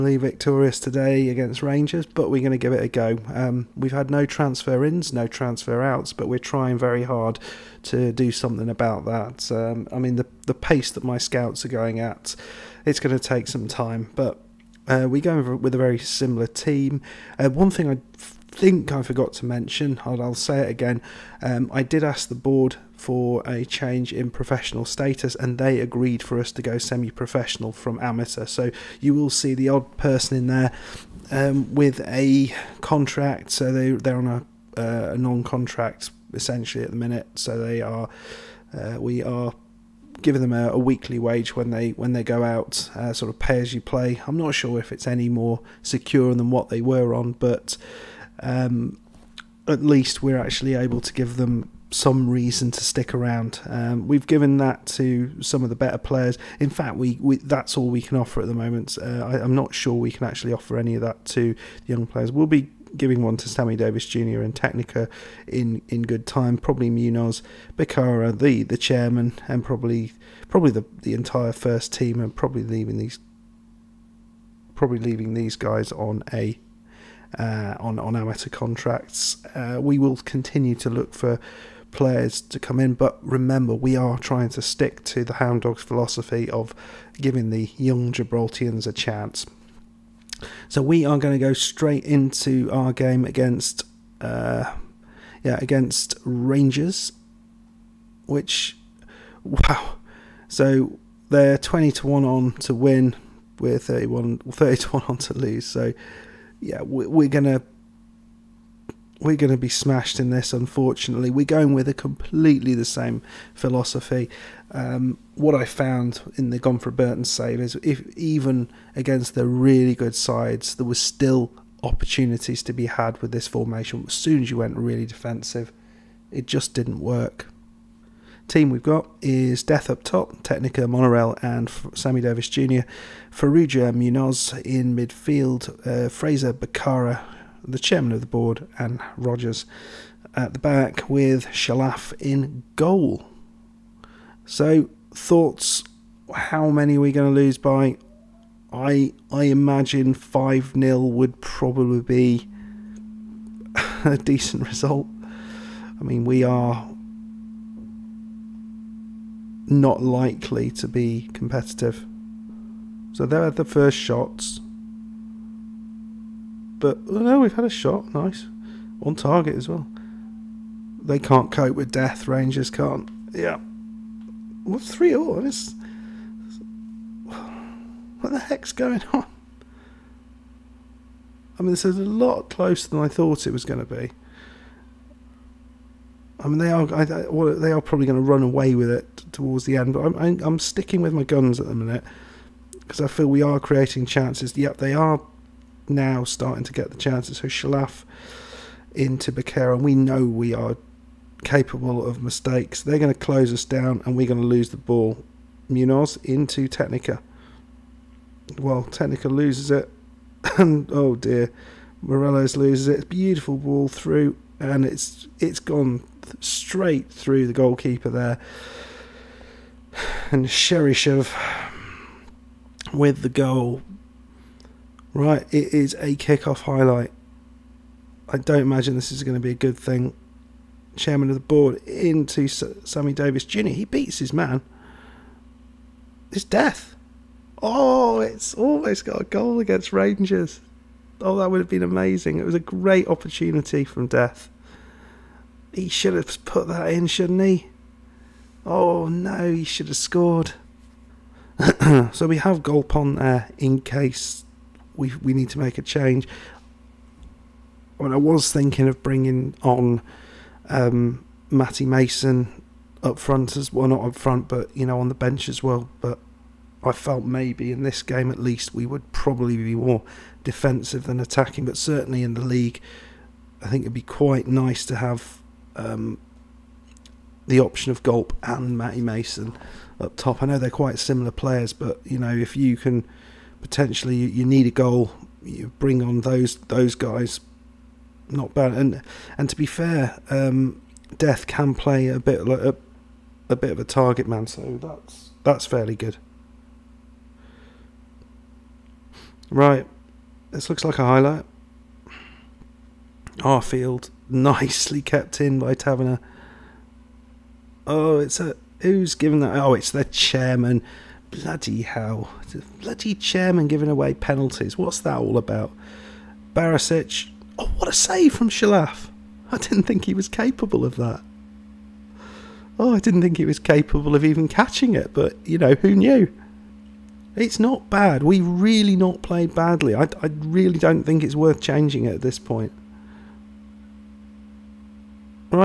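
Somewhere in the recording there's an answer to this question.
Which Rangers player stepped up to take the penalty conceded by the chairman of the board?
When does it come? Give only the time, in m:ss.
5:16.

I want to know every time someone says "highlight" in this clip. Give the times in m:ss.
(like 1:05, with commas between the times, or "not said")
3:46, 5:01.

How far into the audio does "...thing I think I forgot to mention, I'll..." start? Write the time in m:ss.
0:17.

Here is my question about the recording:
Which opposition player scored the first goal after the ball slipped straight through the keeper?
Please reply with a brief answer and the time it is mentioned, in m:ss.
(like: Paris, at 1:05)
Cheryshev, at 3:40.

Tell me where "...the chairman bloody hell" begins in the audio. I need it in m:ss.
5:09.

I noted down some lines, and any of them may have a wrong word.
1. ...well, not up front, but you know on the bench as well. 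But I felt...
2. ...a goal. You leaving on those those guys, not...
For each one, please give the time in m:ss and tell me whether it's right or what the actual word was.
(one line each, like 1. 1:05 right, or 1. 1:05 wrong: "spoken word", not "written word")
1. 4:23 right
2. 4:44 wrong: "bring", not "leaving".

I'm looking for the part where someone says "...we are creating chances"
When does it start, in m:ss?
3:13.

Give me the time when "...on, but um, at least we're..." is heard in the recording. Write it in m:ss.
0:47.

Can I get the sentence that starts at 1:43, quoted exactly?
We're 31, 30 to 1 on to lose.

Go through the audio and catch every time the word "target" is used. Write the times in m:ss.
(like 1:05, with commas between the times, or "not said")
2:49, 4:53.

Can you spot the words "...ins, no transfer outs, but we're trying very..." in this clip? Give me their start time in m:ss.
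0:04.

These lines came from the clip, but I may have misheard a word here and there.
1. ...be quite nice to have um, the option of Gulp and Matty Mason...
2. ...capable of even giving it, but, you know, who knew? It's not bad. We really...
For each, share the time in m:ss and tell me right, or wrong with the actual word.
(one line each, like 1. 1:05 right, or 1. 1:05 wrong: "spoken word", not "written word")
1. 4:33 right
2. 5:23 wrong: "catching", not "giving".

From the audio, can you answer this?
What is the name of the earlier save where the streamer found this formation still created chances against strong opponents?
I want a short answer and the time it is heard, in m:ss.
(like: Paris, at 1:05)
Gone for Burton, at 1:56.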